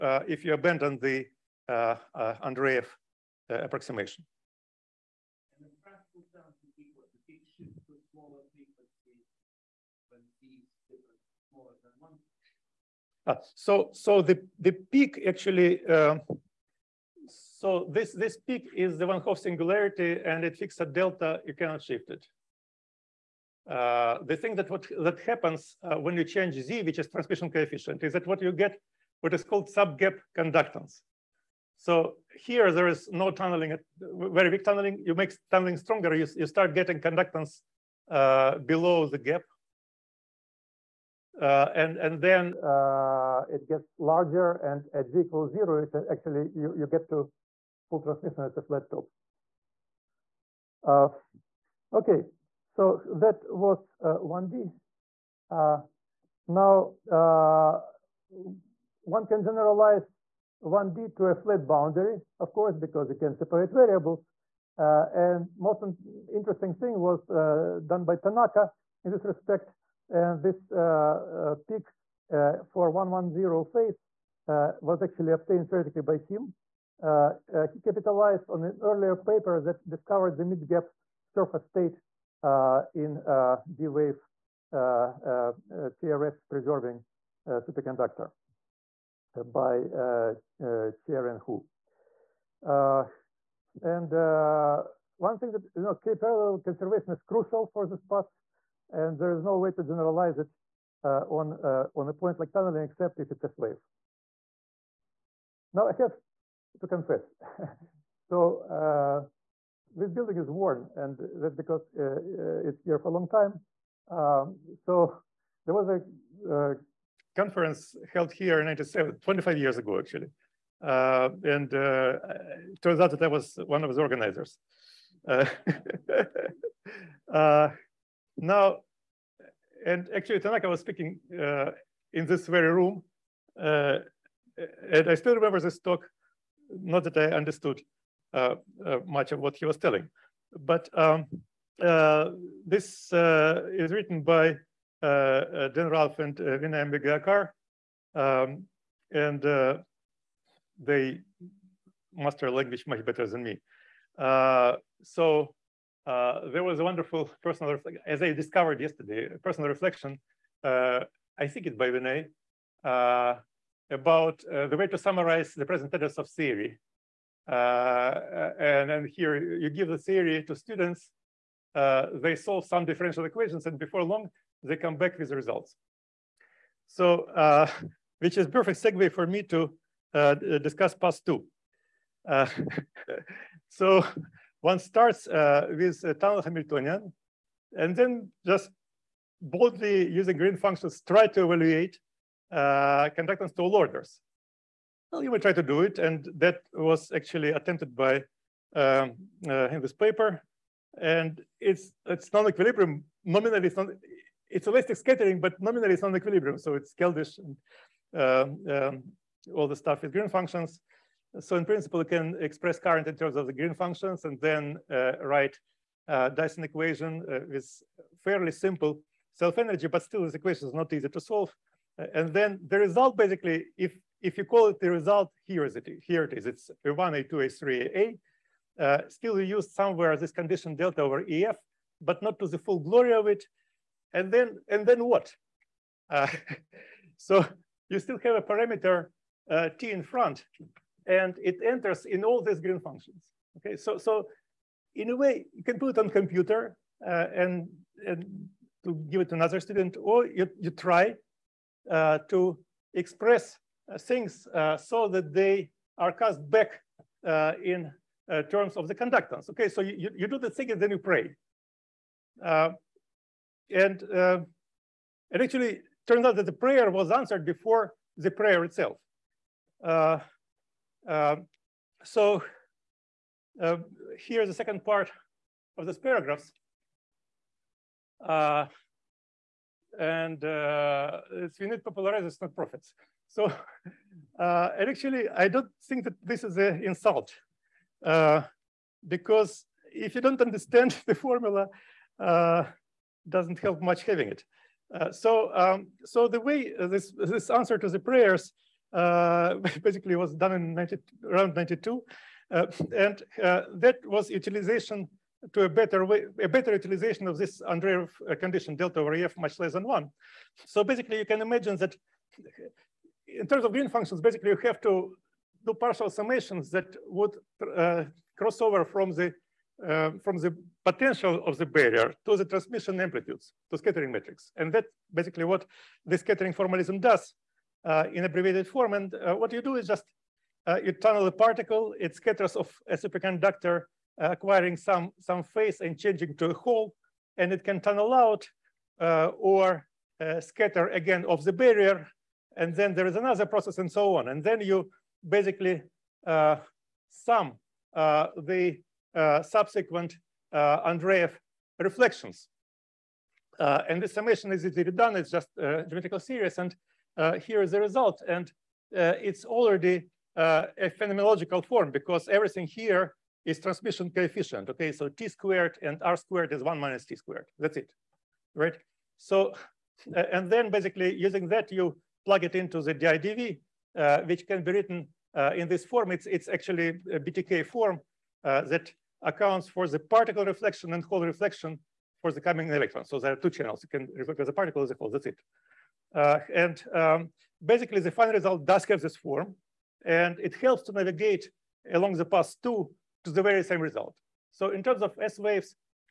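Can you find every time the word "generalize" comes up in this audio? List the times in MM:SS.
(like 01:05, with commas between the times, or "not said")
00:59, 01:39.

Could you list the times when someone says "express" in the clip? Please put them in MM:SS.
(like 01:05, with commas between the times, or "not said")
03:32, 04:12.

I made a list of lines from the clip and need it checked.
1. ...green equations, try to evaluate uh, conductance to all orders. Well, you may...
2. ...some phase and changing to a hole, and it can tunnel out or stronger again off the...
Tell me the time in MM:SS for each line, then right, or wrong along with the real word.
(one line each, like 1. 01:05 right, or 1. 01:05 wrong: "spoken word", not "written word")
1. 03:10 wrong: "functions", not "equations"
2. 05:35 wrong: "scatter", not "stronger".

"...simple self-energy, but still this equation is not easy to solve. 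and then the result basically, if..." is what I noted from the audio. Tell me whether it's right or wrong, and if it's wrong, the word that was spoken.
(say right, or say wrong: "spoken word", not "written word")
right.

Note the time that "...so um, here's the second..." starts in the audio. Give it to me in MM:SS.
04:32.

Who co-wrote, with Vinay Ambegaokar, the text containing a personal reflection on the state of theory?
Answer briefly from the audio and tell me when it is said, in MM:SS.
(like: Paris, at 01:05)
Dan Ralph, at 02:25.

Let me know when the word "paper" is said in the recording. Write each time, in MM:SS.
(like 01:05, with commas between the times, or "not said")
01:19, 03:19.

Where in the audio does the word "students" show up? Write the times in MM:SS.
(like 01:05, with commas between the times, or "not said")
02:50, 04:09.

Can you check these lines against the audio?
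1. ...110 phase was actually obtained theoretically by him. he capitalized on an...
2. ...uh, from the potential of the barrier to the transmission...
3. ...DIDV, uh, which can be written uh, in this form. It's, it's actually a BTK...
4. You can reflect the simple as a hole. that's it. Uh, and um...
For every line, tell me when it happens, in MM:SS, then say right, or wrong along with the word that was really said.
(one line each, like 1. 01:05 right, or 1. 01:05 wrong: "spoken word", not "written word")
1. 01:12 right
2. 05:19 right
3. 06:12 right
4. 06:23 wrong: "particle", not "simple".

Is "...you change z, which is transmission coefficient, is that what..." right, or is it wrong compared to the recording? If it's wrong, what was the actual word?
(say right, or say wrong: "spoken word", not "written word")
right.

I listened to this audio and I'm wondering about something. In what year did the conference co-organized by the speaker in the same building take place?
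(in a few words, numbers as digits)
1997.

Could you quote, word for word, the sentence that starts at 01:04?
and most interesting thing was done by Tanaka in this respect.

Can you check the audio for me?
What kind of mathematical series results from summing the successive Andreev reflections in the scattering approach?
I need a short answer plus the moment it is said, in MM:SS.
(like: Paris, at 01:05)
geometrical series, at 05:55.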